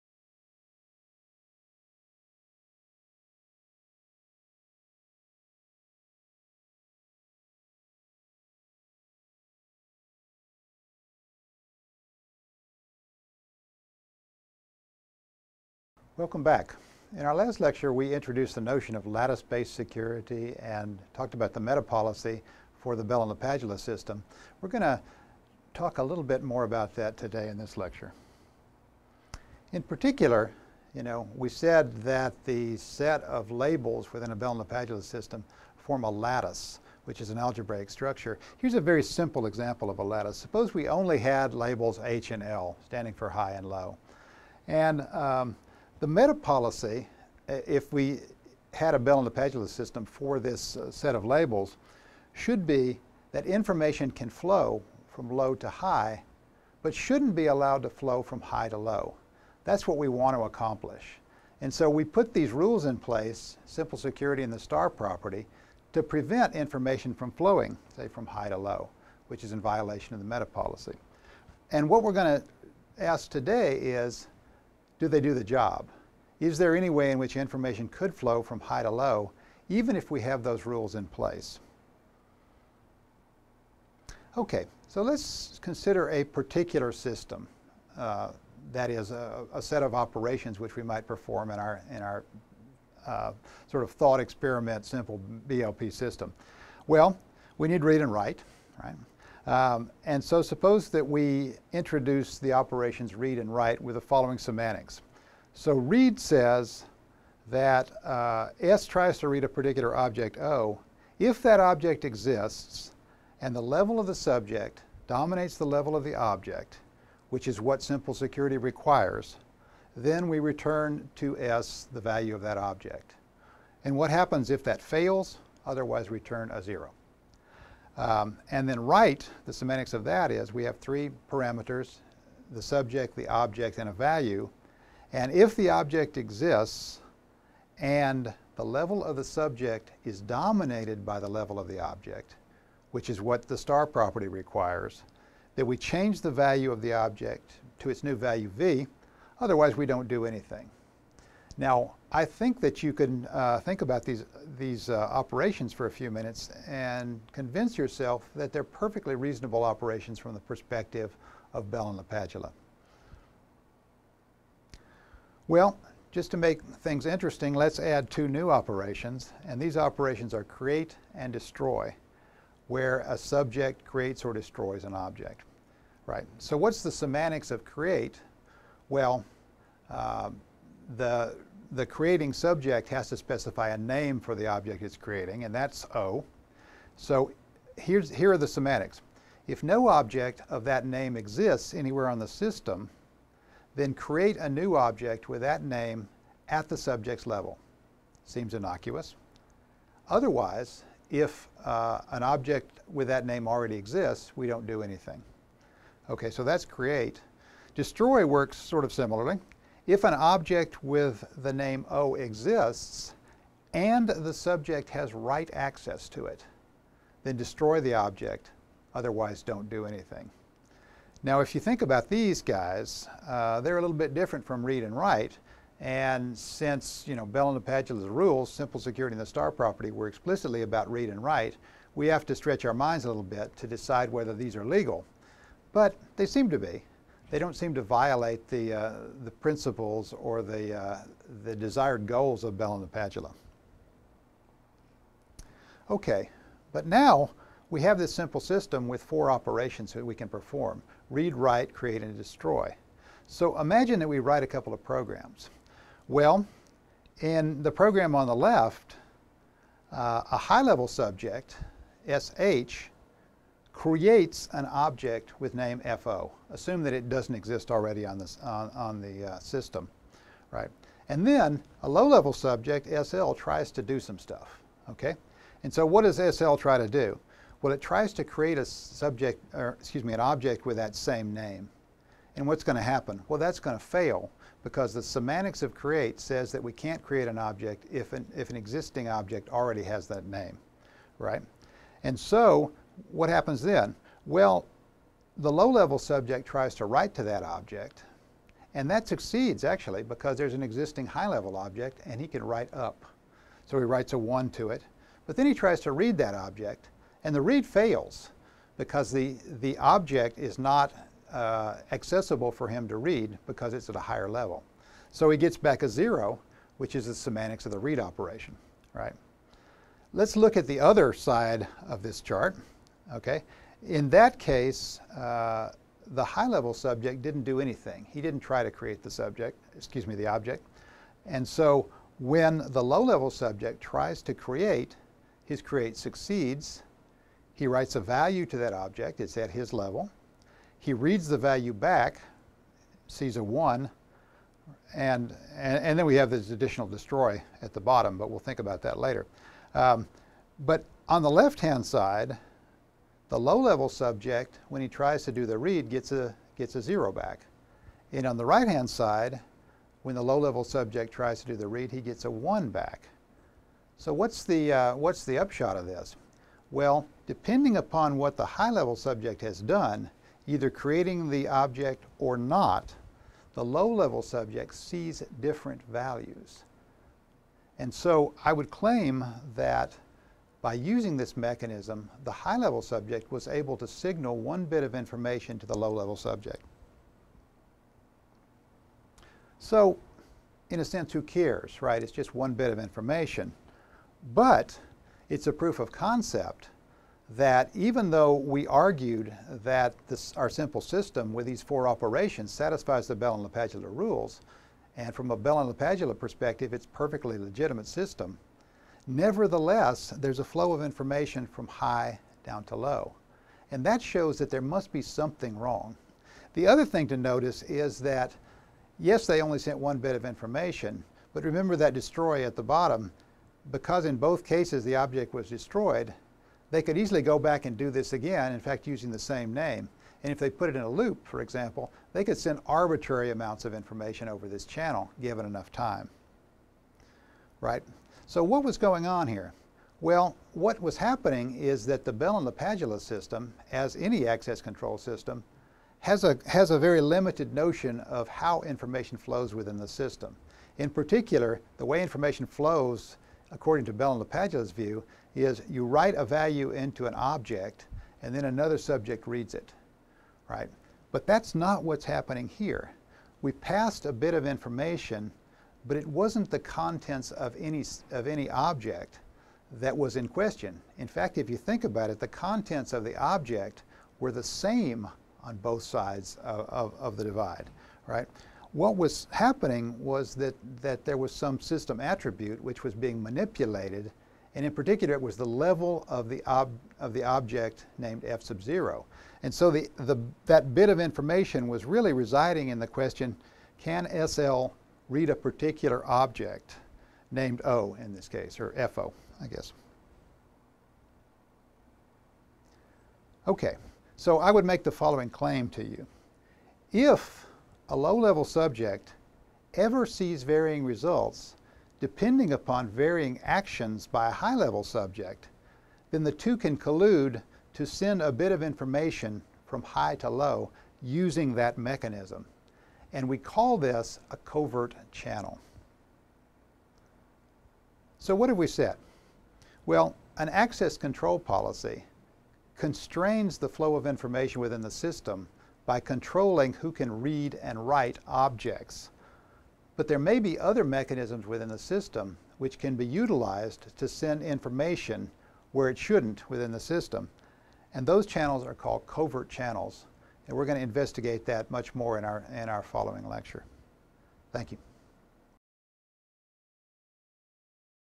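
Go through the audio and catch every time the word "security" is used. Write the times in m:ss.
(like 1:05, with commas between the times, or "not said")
0:19, 1:03, 1:58, 3:48.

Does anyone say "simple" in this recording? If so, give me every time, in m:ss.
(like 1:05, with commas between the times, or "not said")
0:39, 1:03, 1:34, 1:57, 3:48, 4:08, 6:40.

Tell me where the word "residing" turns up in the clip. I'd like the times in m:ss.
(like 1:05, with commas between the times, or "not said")
8:12.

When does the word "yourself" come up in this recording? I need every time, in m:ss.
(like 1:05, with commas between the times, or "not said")
2:37.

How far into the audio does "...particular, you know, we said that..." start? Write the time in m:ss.
0:29.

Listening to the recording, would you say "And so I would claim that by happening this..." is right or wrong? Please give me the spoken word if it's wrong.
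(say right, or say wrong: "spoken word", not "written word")
wrong: "using", not "happening".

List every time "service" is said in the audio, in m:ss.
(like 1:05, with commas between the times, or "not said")
not said.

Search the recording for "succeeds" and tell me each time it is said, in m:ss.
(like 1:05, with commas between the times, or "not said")
4:59, 5:35.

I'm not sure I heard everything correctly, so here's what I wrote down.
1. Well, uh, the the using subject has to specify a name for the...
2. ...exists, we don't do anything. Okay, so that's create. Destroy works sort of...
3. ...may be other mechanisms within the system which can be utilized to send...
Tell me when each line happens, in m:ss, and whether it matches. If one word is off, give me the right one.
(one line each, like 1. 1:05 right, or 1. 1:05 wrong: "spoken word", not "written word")
1. 2:58 wrong: "creating", not "using"
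2. 3:23 right
3. 9:00 right.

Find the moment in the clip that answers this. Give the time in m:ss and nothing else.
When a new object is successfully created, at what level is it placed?
3:16.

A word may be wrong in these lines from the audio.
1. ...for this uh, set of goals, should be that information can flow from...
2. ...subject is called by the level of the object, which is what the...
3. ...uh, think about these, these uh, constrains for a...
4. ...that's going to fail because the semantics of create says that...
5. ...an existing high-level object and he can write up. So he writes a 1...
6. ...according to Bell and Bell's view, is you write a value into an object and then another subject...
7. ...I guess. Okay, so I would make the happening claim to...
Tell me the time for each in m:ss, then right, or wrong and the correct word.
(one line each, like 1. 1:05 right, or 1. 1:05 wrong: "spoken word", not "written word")
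1. 0:50 wrong: "labels", not "goals"
2. 2:19 wrong: "dominated", not "called"
3. 2:33 wrong: "operations", not "constrains"
4. 4:43 right
5. 5:00 right
6. 7:33 wrong: "LaPadula", not "Bell"
7. 8:19 wrong: "following", not "happening".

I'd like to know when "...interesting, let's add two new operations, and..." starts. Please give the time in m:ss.
2:47.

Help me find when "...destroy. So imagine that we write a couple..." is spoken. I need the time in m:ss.
4:12.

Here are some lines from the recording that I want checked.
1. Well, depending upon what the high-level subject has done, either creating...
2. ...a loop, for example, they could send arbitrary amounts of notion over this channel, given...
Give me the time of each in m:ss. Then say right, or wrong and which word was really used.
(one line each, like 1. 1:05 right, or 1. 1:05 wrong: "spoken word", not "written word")
1. 6:06 right
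2. 7:10 wrong: "information", not "notion".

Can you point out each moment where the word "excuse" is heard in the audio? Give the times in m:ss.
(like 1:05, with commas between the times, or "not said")
4:39, 5:29.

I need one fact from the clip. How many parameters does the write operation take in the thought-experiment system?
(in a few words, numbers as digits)
3.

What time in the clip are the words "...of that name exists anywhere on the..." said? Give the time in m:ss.
3:10.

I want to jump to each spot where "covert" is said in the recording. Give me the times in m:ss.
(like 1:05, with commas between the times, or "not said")
8:44, 9:09.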